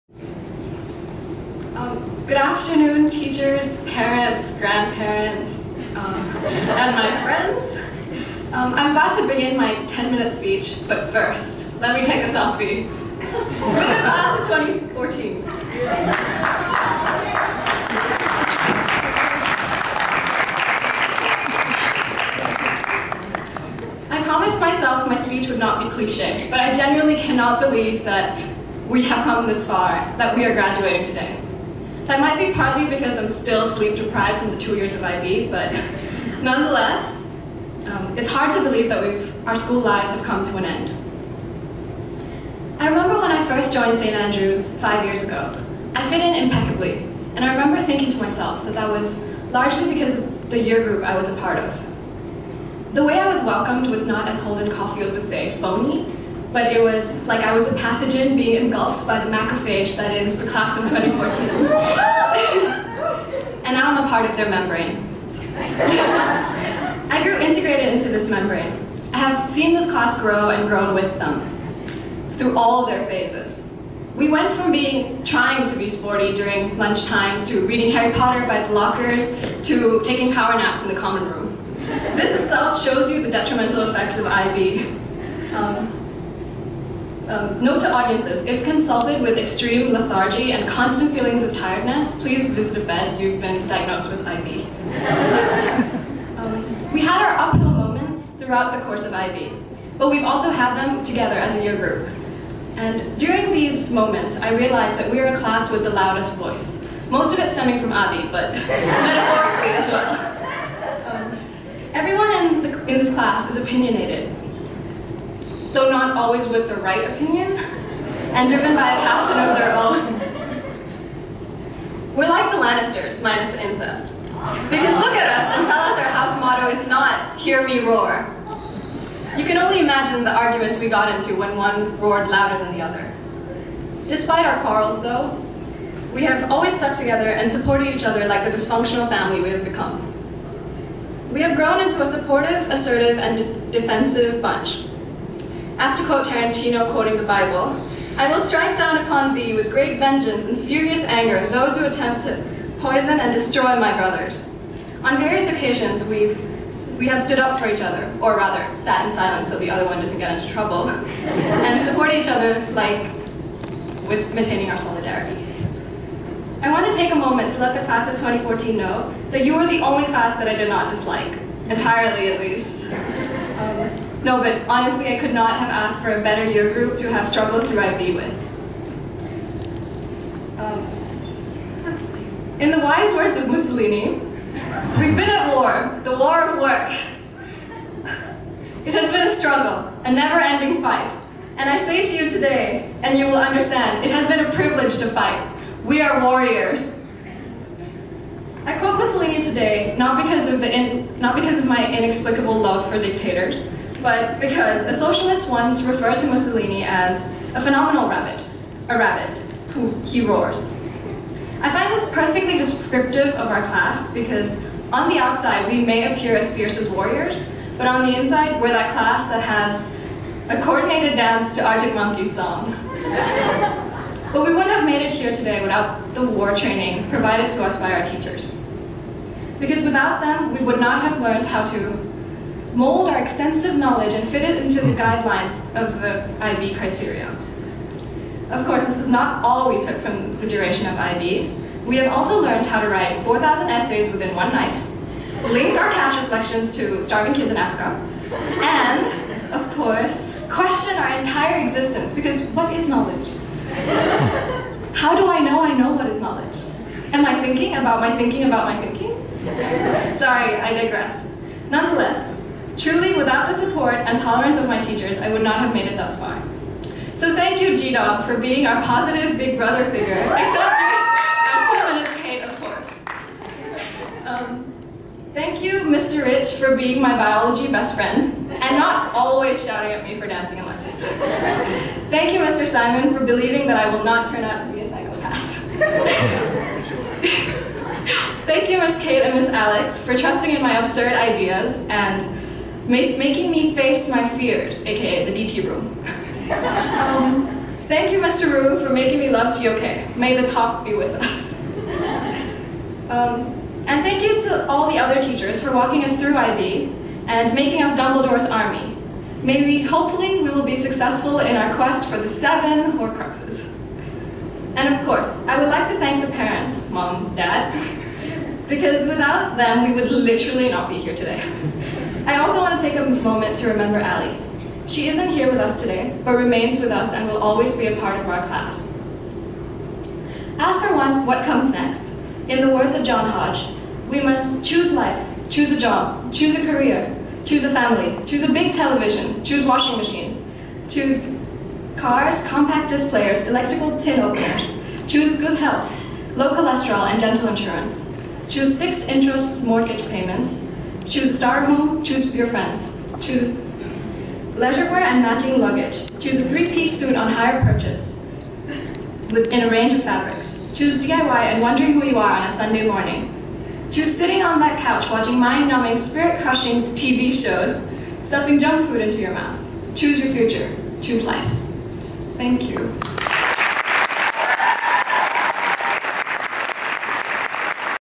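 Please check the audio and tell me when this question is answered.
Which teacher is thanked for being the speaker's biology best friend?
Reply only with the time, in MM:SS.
04:35.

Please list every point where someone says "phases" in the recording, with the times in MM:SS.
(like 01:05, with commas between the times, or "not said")
01:13.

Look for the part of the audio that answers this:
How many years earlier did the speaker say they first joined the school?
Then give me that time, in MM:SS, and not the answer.
00:44.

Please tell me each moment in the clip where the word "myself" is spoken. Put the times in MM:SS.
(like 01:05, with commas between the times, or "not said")
00:24, 00:48.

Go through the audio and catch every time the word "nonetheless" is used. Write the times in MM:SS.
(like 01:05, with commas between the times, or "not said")
00:36, 04:21.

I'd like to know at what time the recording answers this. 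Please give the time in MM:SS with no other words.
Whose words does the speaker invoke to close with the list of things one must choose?
05:33.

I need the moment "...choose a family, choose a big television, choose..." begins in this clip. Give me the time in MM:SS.
05:37.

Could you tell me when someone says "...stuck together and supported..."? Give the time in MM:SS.
02:16.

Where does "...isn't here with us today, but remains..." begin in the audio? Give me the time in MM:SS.
05:25.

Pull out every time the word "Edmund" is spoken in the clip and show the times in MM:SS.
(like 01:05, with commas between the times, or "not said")
not said.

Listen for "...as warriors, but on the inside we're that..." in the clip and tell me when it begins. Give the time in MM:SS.
03:36.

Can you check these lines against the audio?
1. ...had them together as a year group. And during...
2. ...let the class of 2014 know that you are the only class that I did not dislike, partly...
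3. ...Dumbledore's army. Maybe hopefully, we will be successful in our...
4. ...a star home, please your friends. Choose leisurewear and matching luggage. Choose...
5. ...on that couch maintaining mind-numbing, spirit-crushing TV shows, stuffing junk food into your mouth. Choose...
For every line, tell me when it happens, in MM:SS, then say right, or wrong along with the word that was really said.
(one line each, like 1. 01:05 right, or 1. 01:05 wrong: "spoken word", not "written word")
1. 01:40 right
2. 02:47 wrong: "entirely", not "partly"
3. 05:07 right
4. 05:51 wrong: "choose", not "please"
5. 06:04 wrong: "watching", not "maintaining".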